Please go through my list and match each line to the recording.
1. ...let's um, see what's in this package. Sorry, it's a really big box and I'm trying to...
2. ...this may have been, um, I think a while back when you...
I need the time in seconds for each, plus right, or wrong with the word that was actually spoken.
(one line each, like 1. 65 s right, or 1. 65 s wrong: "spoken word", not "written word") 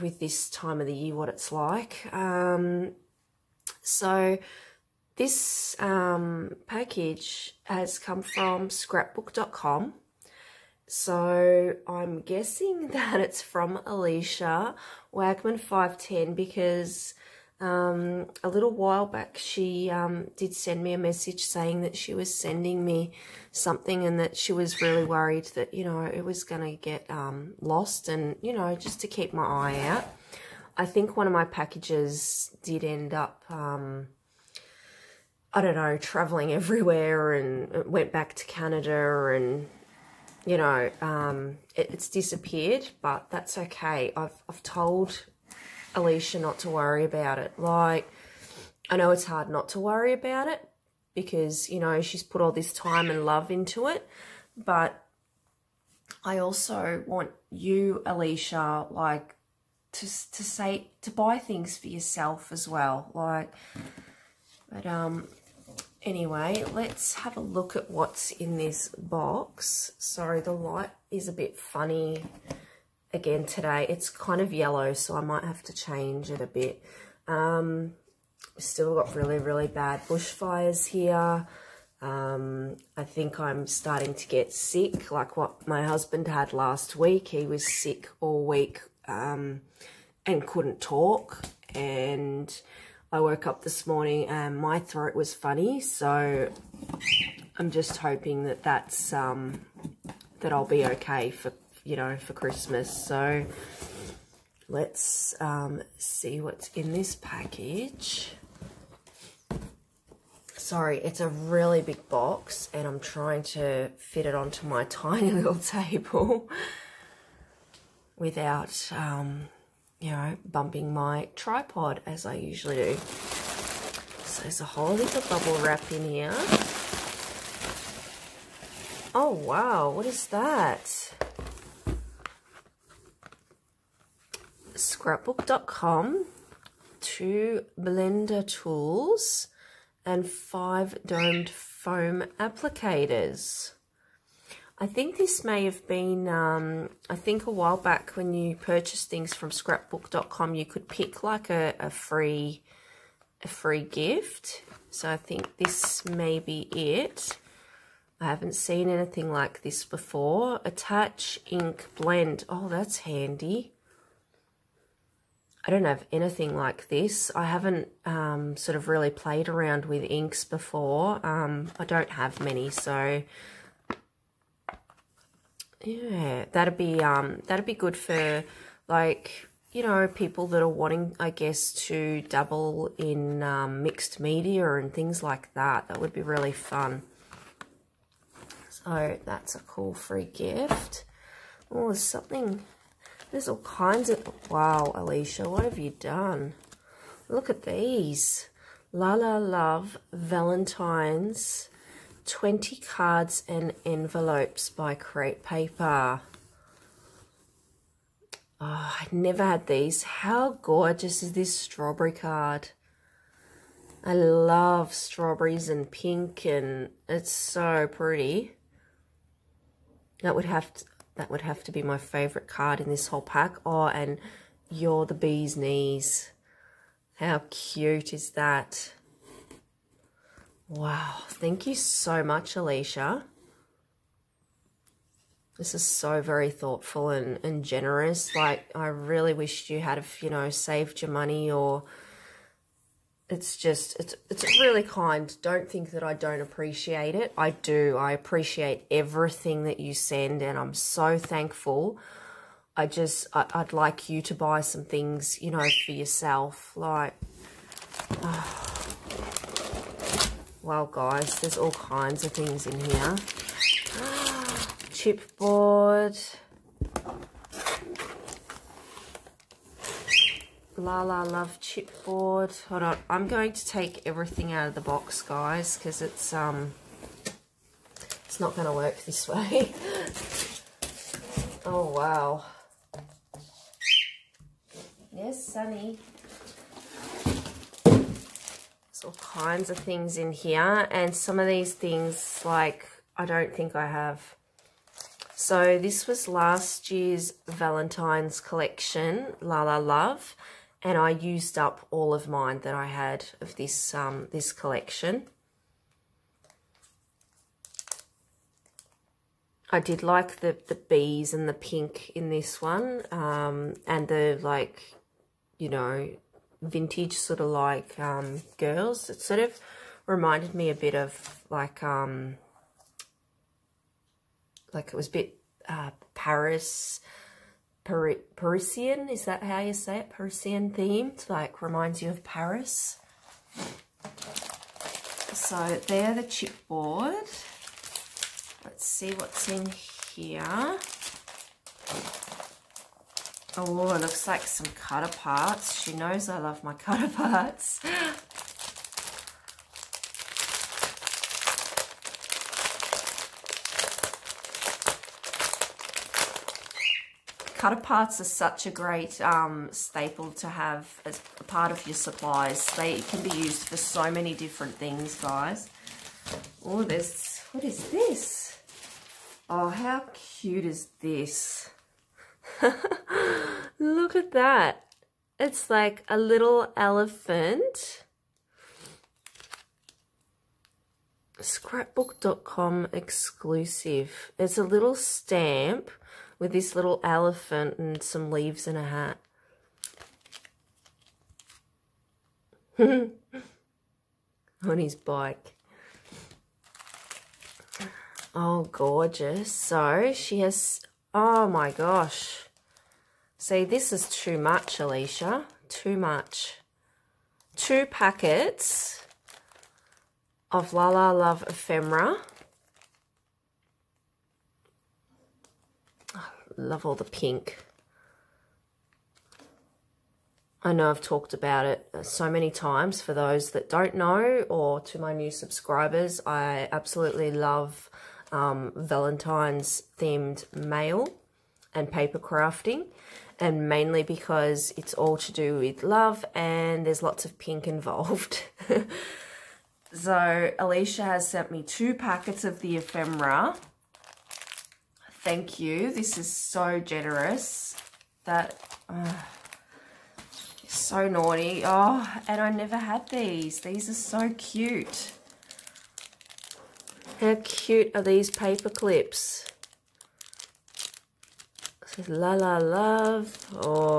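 1. 104 s right
2. 145 s right.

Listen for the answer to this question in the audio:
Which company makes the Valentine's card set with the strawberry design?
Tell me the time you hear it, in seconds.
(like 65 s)
204 s.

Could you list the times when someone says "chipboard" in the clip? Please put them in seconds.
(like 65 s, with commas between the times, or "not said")
265 s, 271 s, 336 s.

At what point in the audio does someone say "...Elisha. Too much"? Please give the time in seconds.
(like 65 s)
404 s.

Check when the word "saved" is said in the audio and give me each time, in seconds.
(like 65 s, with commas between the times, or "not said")
240 s.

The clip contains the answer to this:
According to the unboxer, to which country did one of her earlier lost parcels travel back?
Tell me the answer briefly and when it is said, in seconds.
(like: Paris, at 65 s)
Canada, at 38 s.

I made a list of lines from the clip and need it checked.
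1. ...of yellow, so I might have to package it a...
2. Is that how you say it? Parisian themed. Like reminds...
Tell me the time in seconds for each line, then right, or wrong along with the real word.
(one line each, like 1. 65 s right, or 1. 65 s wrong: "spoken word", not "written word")
1. 74 s wrong: "change", not "package"
2. 329 s right.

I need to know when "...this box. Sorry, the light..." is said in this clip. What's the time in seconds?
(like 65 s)
68 s.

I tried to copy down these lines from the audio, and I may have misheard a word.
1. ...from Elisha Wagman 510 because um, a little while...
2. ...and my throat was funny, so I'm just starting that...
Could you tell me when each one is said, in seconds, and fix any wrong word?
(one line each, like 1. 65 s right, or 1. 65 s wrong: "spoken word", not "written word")
1. 13 s right
2. 94 s wrong: "hoping", not "starting".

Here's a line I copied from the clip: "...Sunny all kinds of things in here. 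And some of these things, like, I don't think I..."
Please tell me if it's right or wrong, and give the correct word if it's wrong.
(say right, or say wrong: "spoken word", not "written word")
right.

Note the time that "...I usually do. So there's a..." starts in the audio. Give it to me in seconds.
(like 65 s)
122 s.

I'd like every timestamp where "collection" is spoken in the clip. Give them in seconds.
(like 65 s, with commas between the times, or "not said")
298 s, 304 s.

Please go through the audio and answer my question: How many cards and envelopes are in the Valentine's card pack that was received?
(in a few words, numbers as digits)
20.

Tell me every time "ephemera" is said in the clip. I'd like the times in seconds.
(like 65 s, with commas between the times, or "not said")
411 s, 442 s.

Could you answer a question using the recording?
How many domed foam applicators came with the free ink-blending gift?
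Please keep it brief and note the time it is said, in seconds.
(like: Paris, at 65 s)
5, at 140 s.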